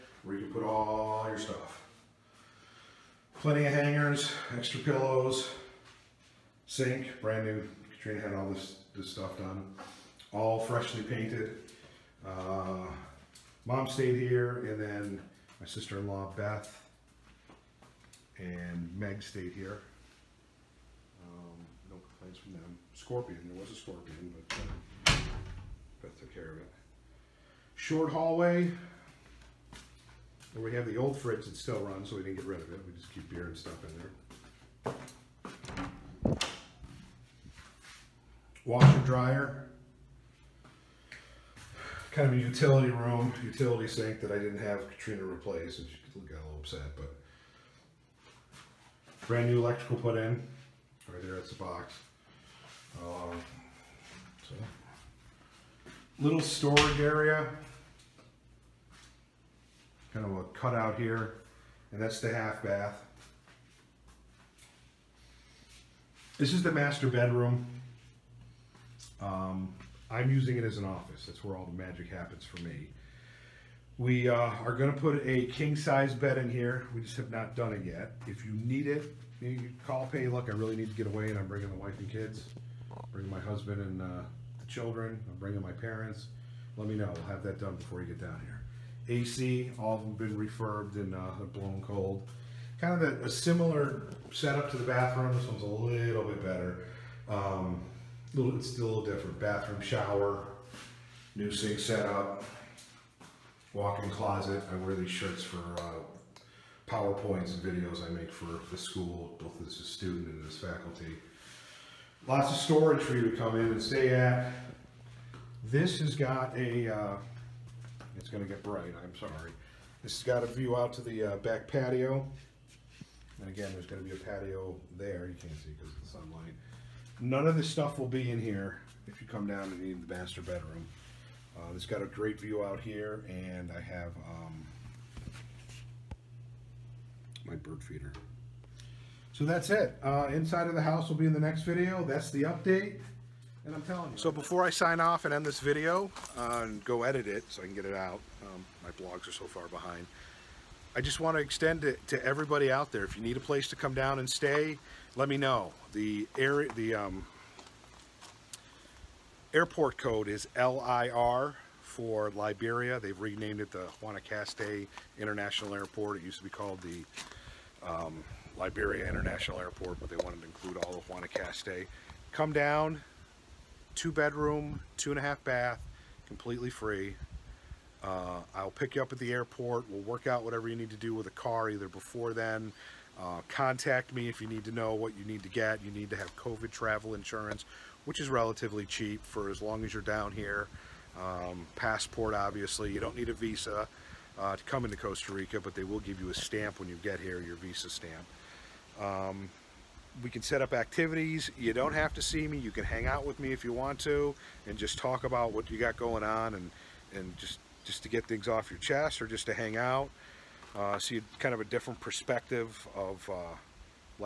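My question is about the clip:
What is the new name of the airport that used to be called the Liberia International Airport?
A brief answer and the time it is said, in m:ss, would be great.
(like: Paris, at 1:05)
Guanacaste International Airport, at 2:44.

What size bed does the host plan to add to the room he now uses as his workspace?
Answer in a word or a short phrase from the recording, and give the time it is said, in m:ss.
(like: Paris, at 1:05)
King-size, at 1:15.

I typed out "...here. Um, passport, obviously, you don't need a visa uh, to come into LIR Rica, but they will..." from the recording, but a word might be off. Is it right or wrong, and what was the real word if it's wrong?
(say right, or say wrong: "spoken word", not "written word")
wrong: "Costa", not "LIR".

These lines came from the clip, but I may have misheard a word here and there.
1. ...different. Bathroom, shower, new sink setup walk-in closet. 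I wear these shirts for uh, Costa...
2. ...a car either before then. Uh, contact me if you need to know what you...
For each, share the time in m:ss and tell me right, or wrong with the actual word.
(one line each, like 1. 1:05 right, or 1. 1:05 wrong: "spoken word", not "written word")
1. 1:39 wrong: "PowerPoints", not "Costa"
2. 3:01 right.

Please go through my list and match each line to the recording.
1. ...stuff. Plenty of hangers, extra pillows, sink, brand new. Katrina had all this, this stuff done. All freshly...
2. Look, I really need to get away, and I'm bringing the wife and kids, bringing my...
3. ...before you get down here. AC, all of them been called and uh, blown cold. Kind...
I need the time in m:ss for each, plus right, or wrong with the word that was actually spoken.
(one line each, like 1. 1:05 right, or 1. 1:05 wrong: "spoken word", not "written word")
1. 0:01 right
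2. 1:20 right
3. 1:27 wrong: "refurbed", not "called".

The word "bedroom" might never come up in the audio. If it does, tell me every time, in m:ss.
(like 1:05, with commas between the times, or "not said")
1:07, 2:10, 2:54.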